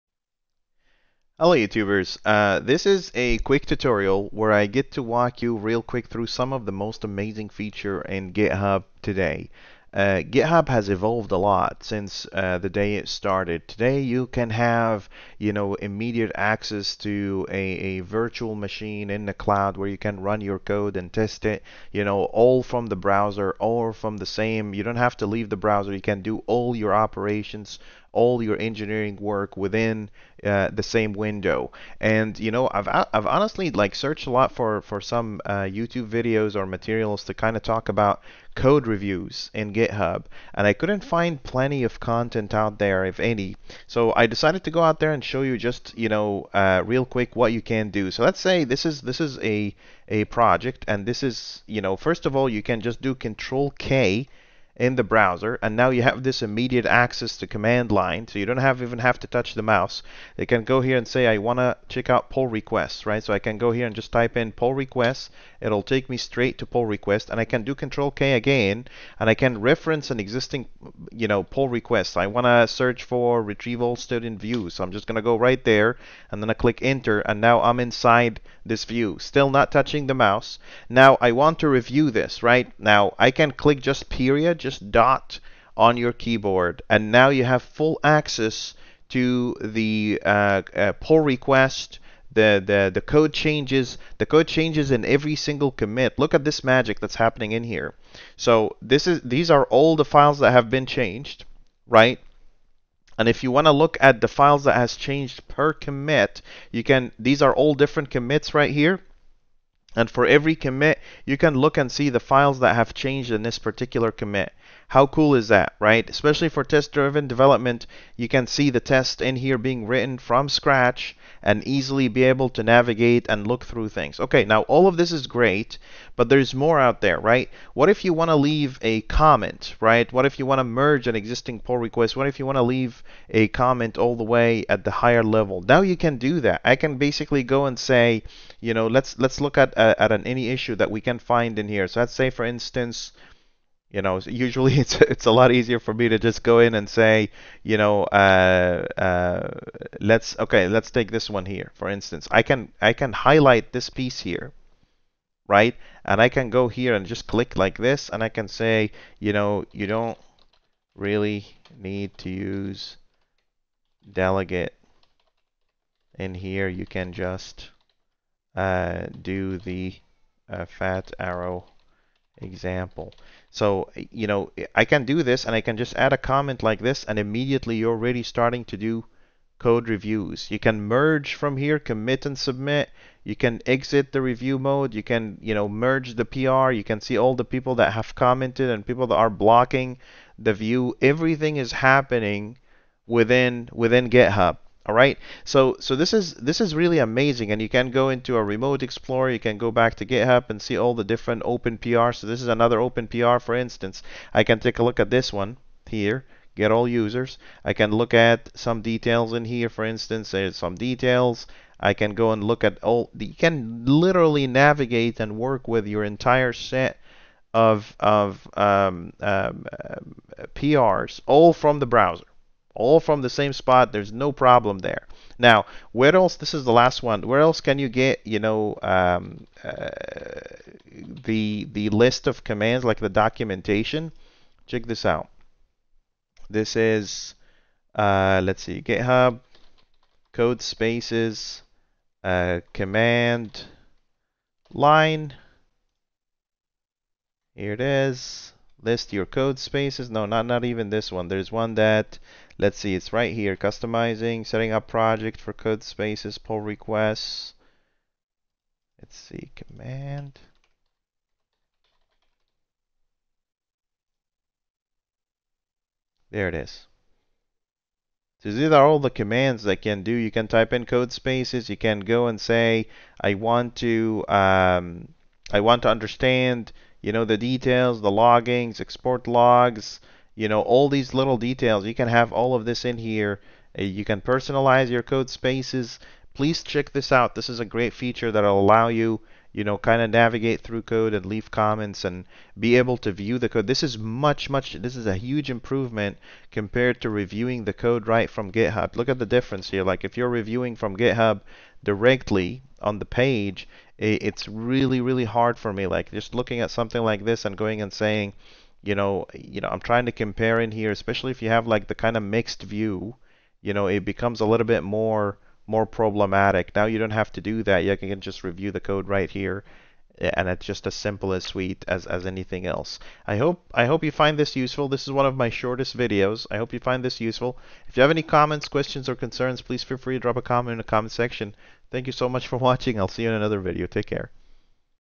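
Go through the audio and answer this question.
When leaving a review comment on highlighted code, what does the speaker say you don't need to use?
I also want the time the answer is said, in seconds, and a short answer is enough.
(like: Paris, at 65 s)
delegate, at 164 s.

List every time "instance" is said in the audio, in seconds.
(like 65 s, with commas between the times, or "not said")
142 s, 151 s, 203 s, 209 s.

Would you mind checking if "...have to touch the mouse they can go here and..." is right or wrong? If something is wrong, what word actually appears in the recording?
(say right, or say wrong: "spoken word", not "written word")
right.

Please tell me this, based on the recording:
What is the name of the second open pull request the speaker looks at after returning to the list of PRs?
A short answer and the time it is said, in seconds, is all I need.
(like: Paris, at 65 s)
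Get all users, at 206 s.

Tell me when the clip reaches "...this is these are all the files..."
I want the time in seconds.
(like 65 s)
98 s.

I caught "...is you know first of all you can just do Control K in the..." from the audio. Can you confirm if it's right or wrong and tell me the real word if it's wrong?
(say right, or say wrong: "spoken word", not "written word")
right.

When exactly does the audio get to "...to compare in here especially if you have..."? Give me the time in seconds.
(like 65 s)
310 s.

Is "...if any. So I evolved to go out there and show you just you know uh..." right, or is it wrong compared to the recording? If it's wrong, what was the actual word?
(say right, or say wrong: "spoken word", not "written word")
wrong: "decided", not "evolved".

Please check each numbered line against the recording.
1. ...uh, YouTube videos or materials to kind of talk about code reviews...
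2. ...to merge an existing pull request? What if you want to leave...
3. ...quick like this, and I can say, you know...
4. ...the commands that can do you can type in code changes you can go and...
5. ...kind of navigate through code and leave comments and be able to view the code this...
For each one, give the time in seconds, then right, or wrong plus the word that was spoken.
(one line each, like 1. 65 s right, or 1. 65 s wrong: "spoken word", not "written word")
1. 35 s right
2. 130 s right
3. 157 s wrong: "click", not "quick"
4. 268 s wrong: "spaces", not "changes"
5. 289 s right.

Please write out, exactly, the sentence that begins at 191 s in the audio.
Everything is happening within within GitHub.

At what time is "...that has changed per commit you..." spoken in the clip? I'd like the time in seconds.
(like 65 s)
104 s.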